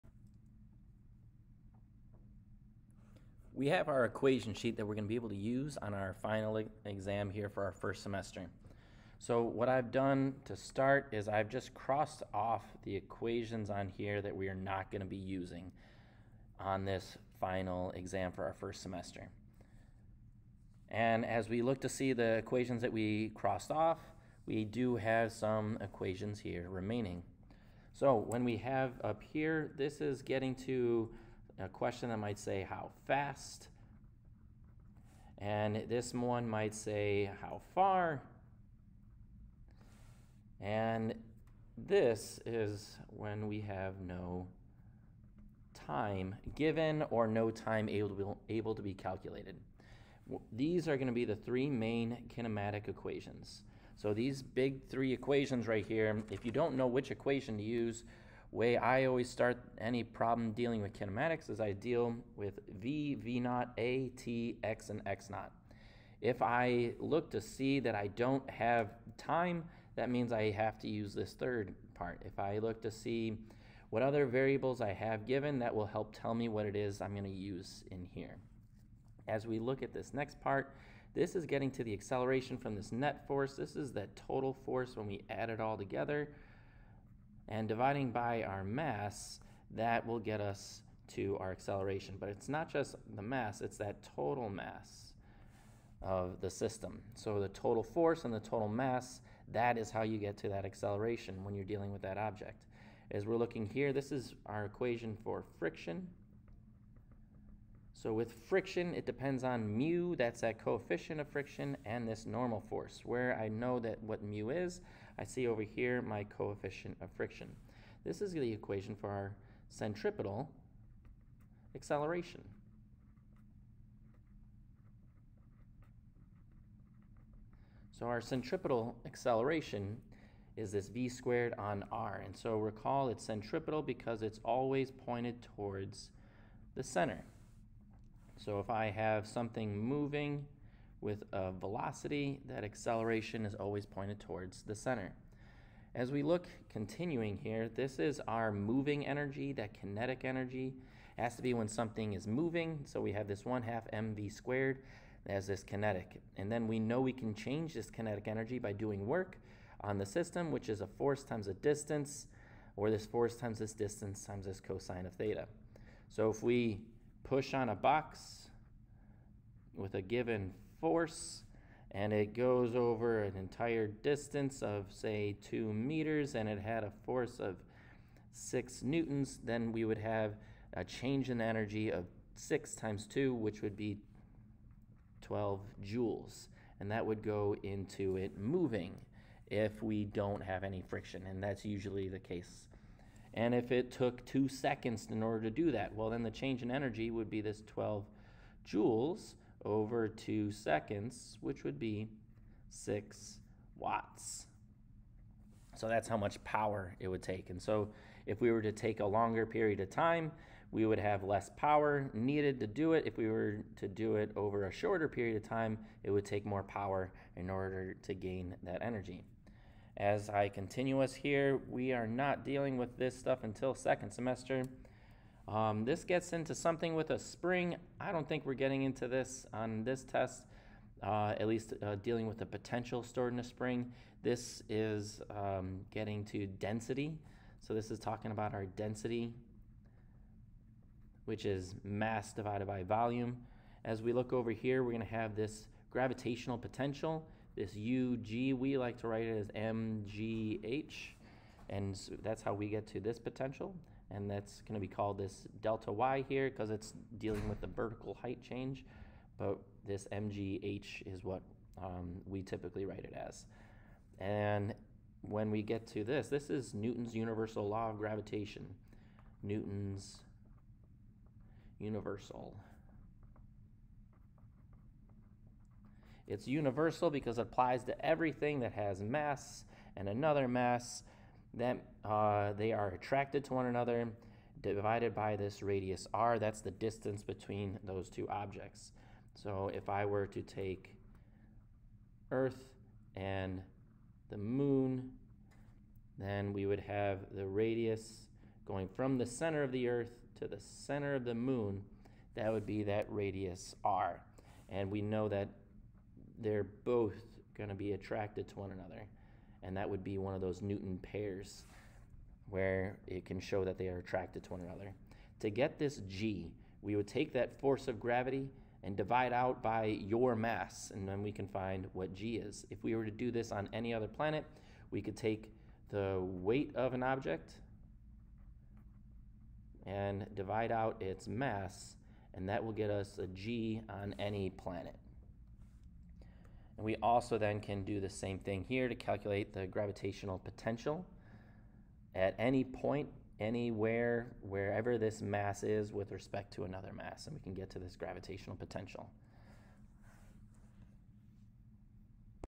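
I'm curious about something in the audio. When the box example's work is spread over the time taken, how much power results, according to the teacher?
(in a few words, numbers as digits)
6 watts.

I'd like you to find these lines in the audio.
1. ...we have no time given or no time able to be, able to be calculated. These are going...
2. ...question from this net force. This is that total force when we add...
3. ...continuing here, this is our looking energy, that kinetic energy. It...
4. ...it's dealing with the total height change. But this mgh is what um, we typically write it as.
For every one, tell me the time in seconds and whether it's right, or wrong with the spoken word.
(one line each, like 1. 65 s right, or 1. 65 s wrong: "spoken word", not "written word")
1. 43 s right
2. 81 s wrong: "acceleration", not "question"
3. 146 s wrong: "moving", not "looking"
4. 256 s wrong: "vertical", not "total".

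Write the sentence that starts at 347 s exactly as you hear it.
And we can get to this gravitational potential.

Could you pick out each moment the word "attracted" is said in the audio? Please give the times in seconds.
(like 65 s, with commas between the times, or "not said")
282 s, 307 s, 313 s.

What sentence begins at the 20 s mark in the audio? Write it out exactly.
And as we look to see the equations that we crossed off, we do have some equations here remaining.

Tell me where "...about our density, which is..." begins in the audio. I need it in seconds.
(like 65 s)
238 s.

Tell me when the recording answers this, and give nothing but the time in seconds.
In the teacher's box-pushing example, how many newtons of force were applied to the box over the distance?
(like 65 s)
178 s.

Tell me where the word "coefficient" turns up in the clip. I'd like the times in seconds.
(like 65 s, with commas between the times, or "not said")
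110 s, 116 s.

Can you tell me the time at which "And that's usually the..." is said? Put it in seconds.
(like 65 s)
191 s.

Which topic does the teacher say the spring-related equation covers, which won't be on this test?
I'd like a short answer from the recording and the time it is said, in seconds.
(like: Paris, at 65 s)
potential stored in a spring, at 232 s.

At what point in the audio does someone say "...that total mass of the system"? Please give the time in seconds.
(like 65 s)
93 s.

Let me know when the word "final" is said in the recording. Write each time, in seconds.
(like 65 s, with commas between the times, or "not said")
6 s, 17 s.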